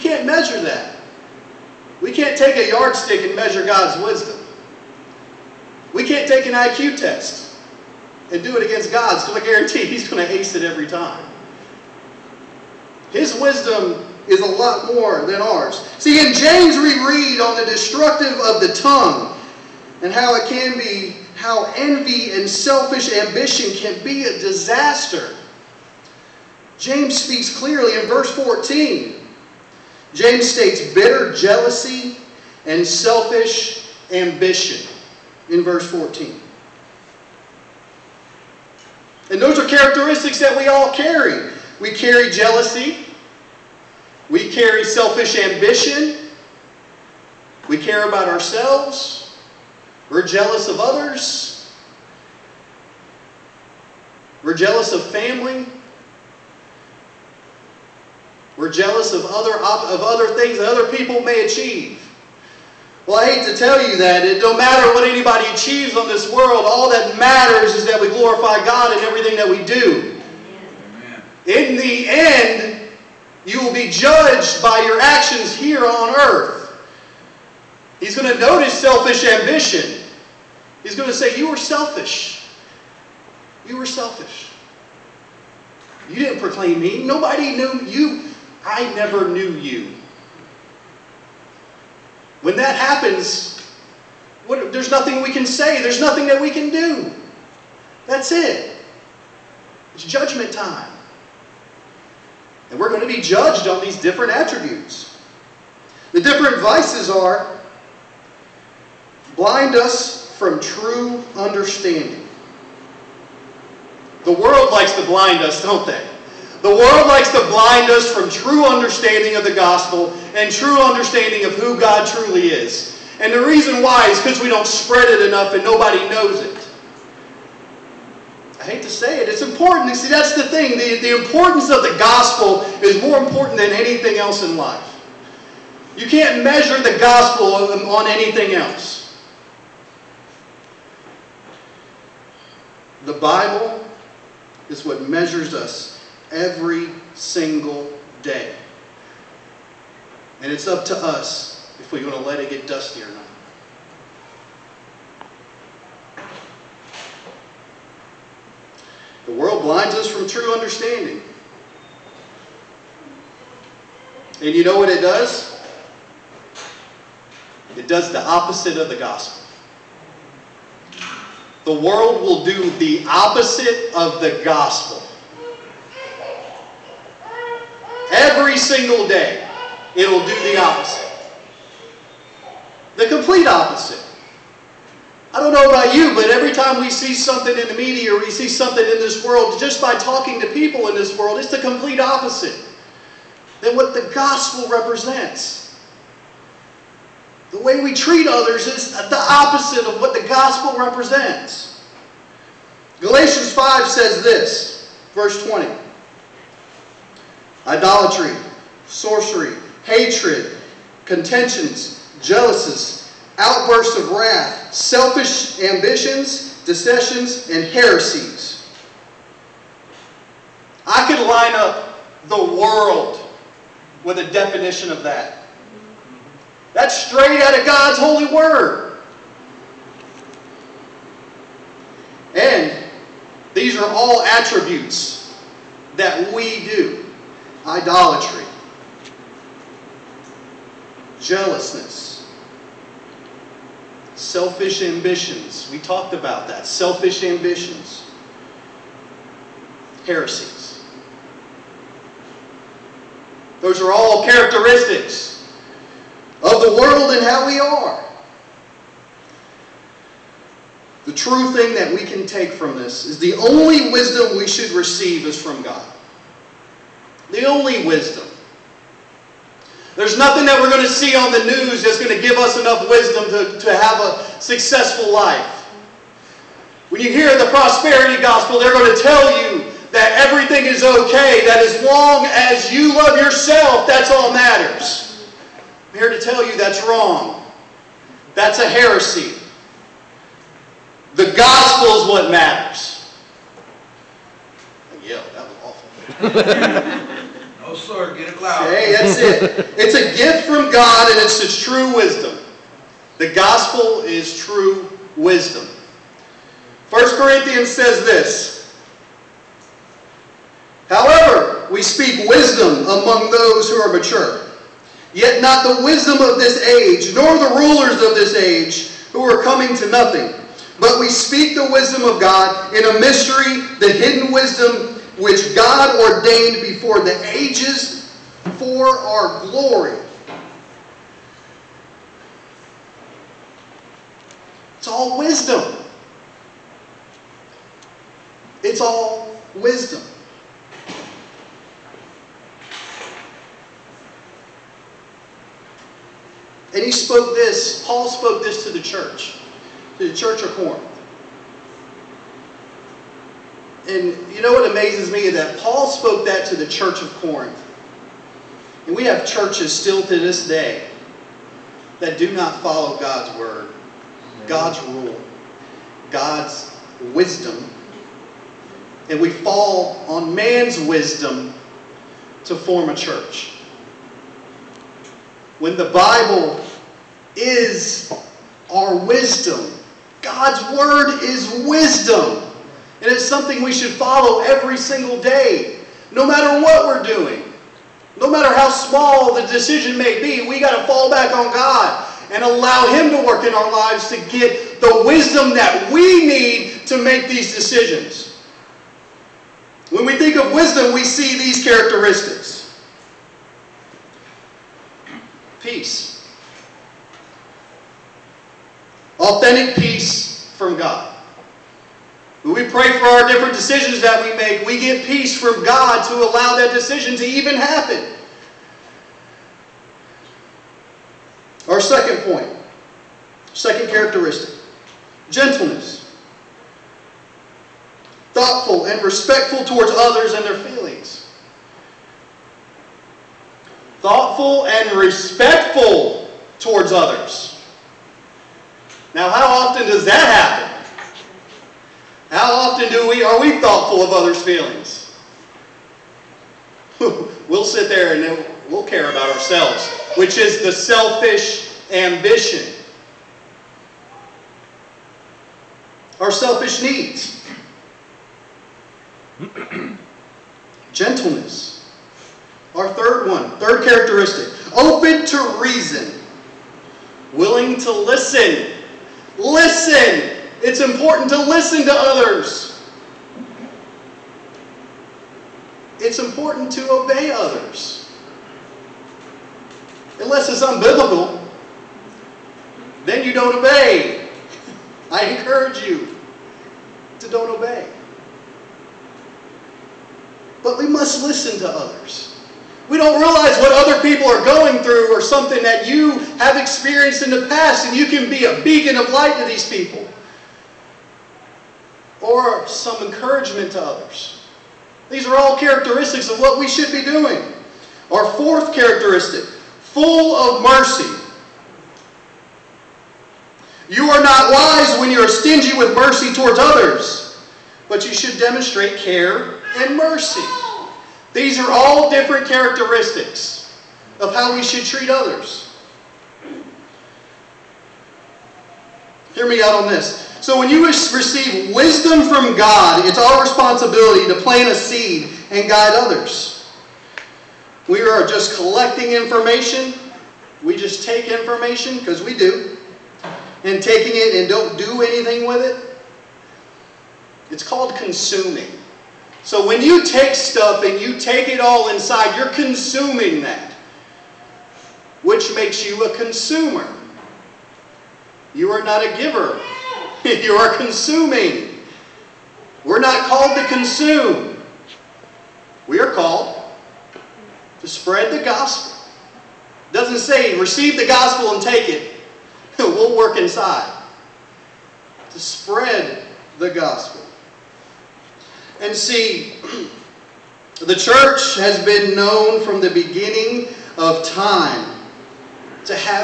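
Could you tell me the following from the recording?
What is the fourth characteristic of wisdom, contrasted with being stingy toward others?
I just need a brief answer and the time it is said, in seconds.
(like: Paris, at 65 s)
full of mercy, at 509 s.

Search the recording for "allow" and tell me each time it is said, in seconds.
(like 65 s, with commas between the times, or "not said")
392 s, 416 s.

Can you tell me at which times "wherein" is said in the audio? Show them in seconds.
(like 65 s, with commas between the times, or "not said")
not said.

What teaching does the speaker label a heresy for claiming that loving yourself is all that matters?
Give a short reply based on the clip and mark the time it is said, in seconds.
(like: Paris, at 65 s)
prosperity gospel, at 277 s.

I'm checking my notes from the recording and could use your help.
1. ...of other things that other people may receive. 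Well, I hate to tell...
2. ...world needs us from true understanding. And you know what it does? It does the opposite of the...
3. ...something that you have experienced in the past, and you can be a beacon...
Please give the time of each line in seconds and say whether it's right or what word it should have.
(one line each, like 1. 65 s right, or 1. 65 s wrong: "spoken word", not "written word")
1. 59 s wrong: "achieve", not "receive"
2. 159 s wrong: "blinds", not "needs"
3. 495 s right.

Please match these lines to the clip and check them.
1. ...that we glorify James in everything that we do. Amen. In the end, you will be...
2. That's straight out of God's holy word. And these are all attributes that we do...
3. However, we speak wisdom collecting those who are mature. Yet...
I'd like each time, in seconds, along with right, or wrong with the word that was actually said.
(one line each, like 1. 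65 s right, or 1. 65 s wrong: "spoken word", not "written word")
1. 67 s wrong: "God", not "James"
2. 226 s right
3. 310 s wrong: "among", not "collecting".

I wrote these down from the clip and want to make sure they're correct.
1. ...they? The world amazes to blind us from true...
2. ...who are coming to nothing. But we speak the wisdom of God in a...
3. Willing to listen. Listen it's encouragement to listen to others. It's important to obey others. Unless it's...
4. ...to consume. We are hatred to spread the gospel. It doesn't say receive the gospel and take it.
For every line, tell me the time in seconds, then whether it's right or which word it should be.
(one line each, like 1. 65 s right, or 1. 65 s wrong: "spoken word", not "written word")
1. 115 s wrong: "likes", not "amazes"
2. 319 s right
3. 467 s wrong: "important", not "encouragement"
4. 563 s wrong: "called", not "hatred".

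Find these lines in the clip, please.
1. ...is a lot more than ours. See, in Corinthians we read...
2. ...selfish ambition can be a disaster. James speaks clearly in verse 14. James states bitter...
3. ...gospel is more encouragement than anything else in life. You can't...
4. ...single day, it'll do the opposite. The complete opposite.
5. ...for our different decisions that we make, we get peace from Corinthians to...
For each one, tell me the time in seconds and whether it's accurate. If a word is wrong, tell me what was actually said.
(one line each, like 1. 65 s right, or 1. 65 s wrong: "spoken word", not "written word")
1. 14 s wrong: "James", not "Corinthians"
2. 22 s right
3. 131 s wrong: "important", not "encouragement"
4. 178 s right
5. 412 s wrong: "God", not "Corinthians".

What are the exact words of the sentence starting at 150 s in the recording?
And it's up to us if we're going to let it get dusty or not.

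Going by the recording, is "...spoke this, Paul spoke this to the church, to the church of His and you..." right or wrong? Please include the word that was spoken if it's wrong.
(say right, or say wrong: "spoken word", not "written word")
wrong: "Corinth", not "His".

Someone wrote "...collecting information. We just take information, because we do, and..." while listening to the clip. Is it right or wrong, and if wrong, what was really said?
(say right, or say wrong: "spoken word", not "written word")
right.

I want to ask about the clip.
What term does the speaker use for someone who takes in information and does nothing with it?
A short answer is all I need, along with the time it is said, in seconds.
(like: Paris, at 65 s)
consumer, at 556 s.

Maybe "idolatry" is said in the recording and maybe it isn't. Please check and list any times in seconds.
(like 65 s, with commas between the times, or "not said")
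207 s, 237 s.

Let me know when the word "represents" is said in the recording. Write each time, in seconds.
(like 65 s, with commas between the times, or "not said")
194 s, 200 s.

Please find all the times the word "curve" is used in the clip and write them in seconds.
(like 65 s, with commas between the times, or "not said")
not said.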